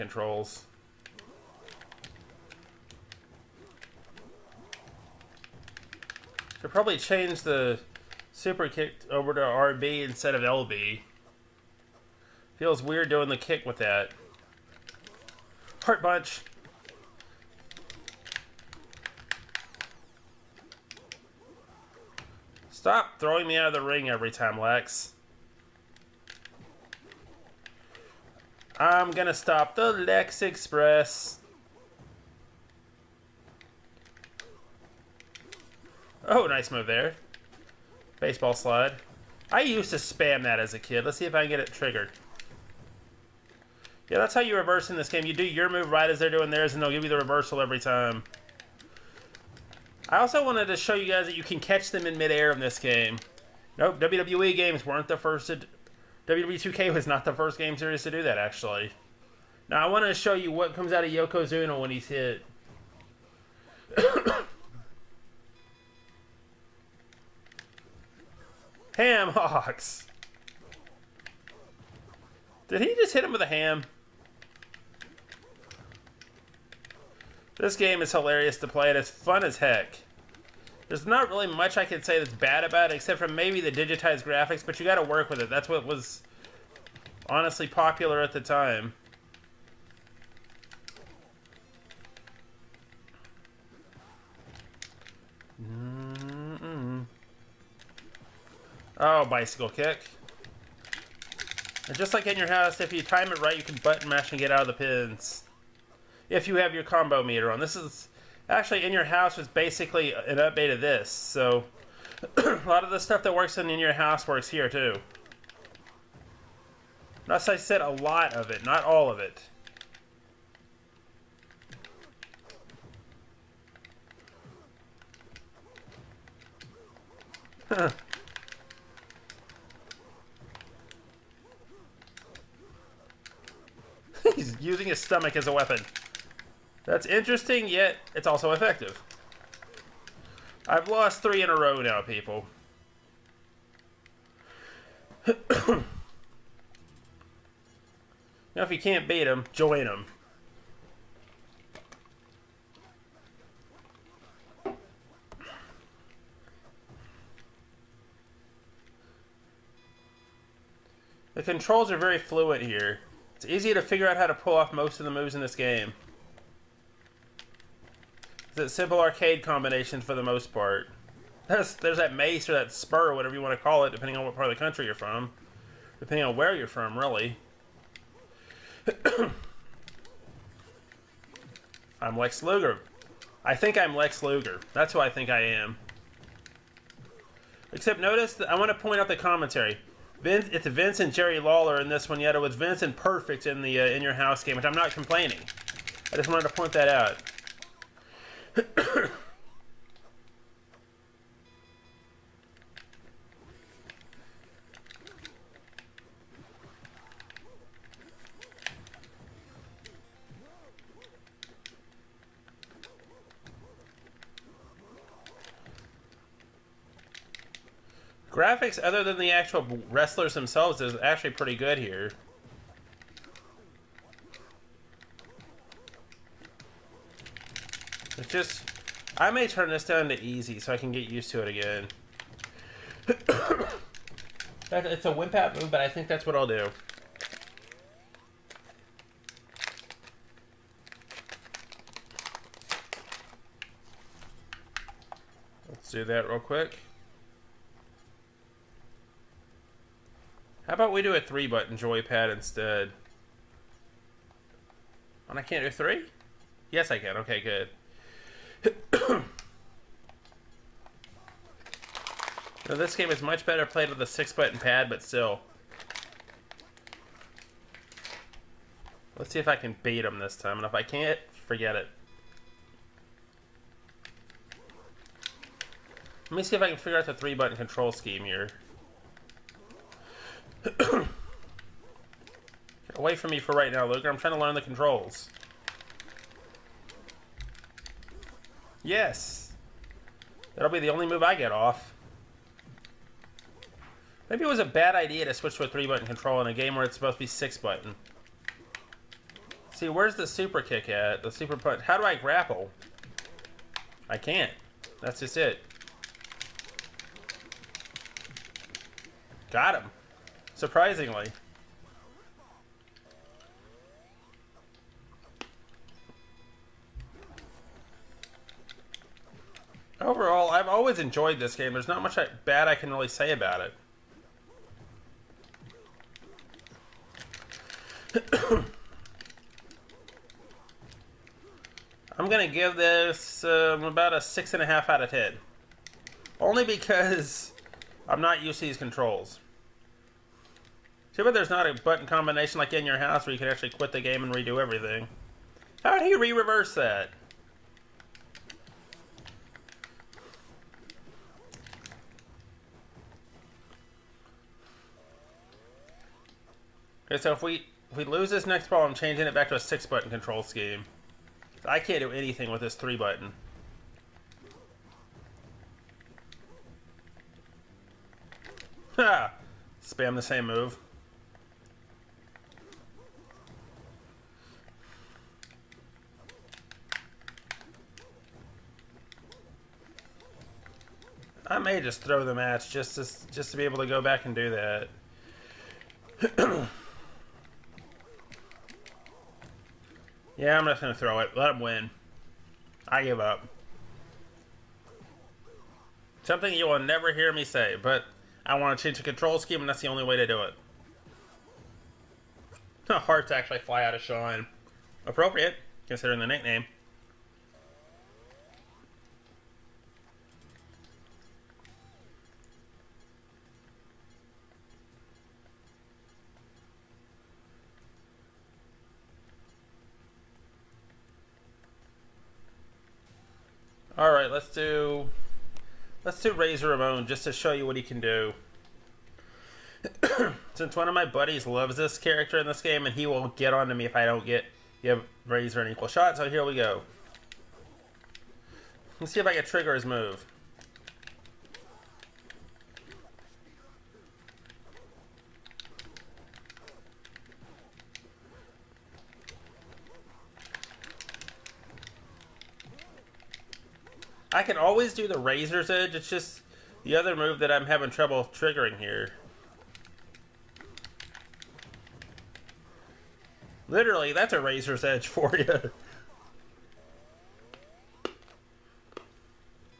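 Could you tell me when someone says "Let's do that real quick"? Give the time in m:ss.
4:05.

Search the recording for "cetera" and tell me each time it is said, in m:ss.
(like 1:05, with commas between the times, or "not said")
not said.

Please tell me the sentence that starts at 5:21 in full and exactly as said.
There's not much bad I can really say about it.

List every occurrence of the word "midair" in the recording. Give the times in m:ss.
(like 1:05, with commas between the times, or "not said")
0:52.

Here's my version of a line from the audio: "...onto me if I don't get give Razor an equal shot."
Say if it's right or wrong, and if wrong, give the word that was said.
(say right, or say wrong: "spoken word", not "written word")
right.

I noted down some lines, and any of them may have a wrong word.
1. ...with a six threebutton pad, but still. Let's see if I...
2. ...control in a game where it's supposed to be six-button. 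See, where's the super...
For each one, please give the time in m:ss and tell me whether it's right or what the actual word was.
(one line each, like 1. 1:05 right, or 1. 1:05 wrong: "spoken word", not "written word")
1. 4:23 wrong: "button", not "threebutton"
2. 4:56 right.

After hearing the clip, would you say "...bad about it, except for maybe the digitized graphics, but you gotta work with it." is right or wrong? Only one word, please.
right.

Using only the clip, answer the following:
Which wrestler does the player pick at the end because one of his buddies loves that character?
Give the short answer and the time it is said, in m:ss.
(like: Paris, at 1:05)
Razor Ramon, at 7:06.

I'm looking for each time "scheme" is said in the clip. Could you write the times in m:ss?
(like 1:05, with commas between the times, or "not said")
4:37, 6:00, 6:39.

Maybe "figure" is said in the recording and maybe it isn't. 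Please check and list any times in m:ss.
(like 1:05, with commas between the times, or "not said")
2:43, 4:36.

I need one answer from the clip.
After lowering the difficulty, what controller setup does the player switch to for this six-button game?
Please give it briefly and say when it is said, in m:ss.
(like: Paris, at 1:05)
Three button joypad, at 4:11.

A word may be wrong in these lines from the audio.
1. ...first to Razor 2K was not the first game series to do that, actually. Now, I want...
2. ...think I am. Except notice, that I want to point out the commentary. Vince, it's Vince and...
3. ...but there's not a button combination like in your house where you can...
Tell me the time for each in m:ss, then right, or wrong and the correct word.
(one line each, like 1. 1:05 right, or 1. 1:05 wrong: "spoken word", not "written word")
1. 0:55 wrong: "WWE", not "Razor"
2. 3:05 right
3. 5:41 right.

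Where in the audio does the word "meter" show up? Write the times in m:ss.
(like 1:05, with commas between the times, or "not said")
1:47.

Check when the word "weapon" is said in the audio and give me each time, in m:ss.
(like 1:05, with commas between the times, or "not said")
2:15.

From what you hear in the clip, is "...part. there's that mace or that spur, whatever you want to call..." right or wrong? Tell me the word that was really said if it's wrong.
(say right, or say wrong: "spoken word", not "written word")
right.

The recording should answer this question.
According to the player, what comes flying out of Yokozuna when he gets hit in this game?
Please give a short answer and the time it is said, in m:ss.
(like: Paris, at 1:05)
Ham hocks, at 1:08.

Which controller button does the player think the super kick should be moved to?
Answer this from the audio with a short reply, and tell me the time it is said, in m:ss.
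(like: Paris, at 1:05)
RB, at 0:09.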